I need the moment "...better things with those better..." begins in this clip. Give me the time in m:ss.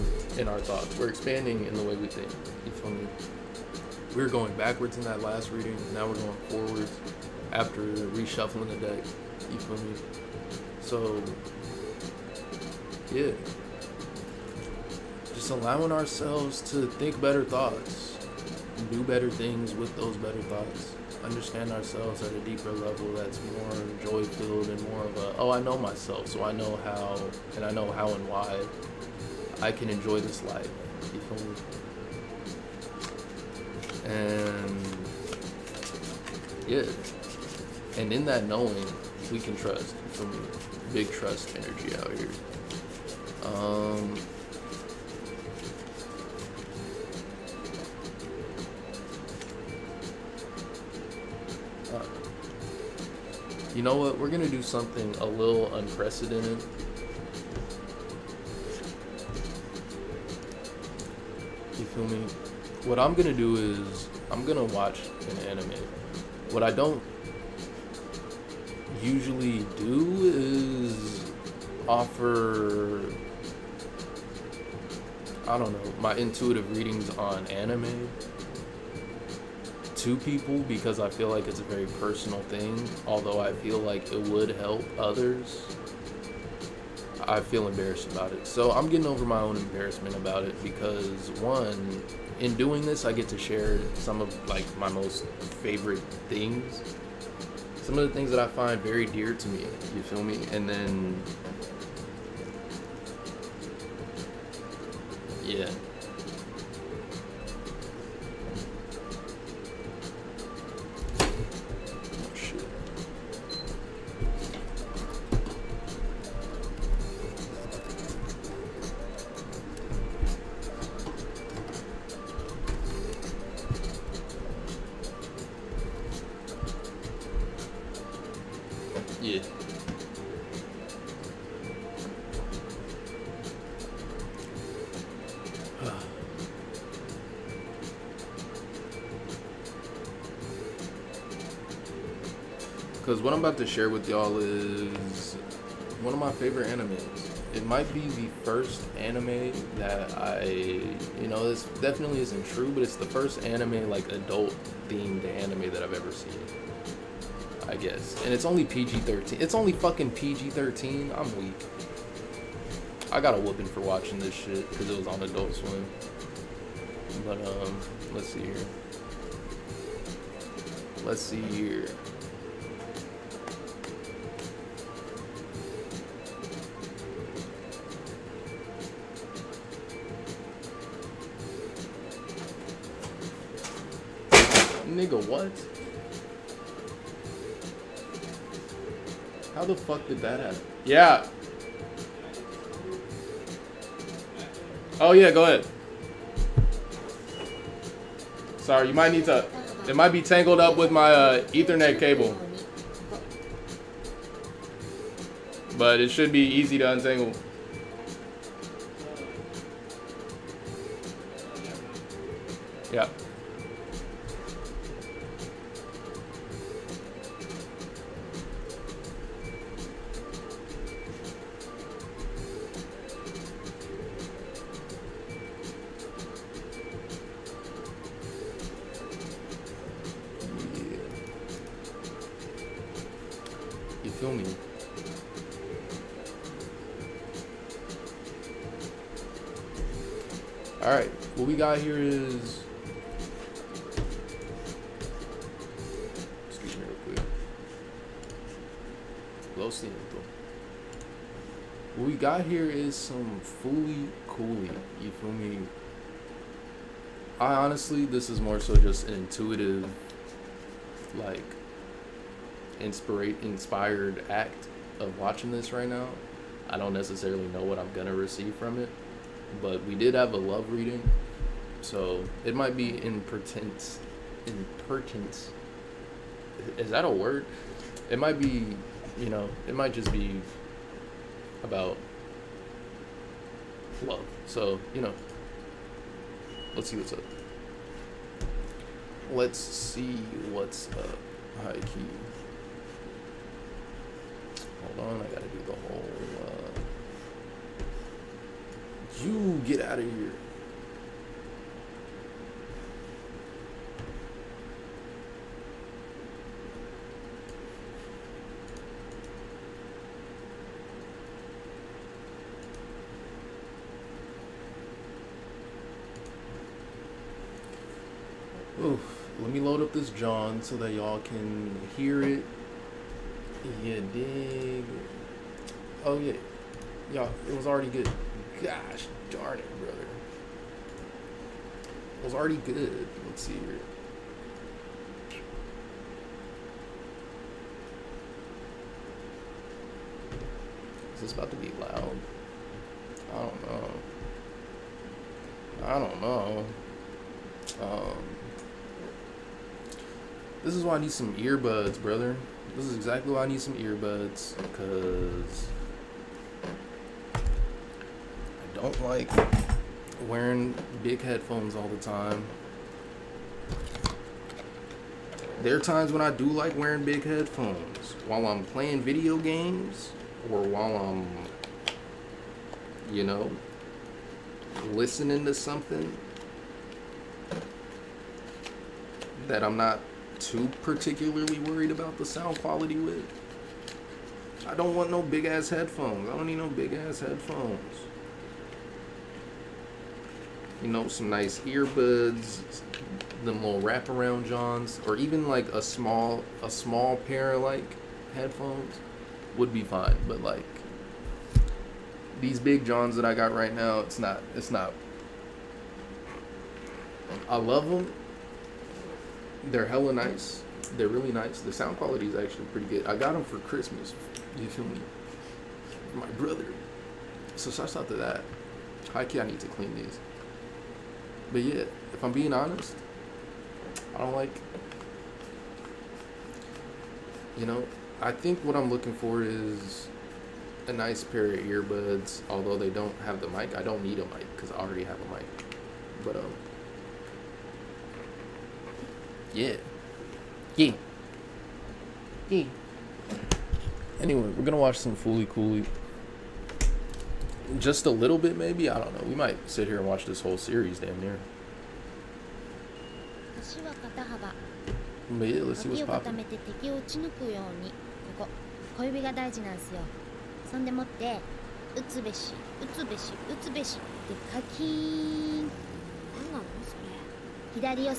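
0:19.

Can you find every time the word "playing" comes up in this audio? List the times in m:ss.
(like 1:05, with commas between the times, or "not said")
6:08.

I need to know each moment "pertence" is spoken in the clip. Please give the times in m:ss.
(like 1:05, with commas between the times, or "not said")
4:33.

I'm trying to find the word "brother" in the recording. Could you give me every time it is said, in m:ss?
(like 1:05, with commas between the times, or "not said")
5:29, 5:52, 6:56.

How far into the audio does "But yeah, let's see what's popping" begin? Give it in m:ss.
7:35.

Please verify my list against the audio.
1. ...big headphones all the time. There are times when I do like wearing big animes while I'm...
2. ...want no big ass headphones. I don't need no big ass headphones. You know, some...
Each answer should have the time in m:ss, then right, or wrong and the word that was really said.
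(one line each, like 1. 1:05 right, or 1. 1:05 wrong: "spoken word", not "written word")
1. 6:01 wrong: "headphones", not "animes"
2. 6:24 right.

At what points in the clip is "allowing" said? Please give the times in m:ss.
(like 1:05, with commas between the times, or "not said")
0:15.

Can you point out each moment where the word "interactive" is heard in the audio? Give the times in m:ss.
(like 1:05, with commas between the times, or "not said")
not said.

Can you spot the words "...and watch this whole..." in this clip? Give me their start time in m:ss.
7:29.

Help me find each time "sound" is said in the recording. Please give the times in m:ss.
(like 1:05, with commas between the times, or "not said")
6:22, 6:51.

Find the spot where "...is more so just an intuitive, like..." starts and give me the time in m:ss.
4:18.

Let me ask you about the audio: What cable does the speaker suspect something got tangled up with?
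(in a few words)
Ethernet cable.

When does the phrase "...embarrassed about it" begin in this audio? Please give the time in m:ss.
1:27.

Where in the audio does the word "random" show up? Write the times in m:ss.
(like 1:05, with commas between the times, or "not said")
not said.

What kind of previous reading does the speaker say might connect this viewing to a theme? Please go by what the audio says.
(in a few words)
A love reading.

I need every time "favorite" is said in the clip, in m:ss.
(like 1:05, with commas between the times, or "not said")
1:35, 2:26.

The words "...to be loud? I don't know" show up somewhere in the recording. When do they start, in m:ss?
5:41.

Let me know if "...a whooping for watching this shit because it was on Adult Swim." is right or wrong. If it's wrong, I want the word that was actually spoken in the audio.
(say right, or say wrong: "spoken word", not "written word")
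right.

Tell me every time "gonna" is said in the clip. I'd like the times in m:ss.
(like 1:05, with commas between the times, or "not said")
4:27, 7:24.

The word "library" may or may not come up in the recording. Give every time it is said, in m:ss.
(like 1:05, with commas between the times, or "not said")
not said.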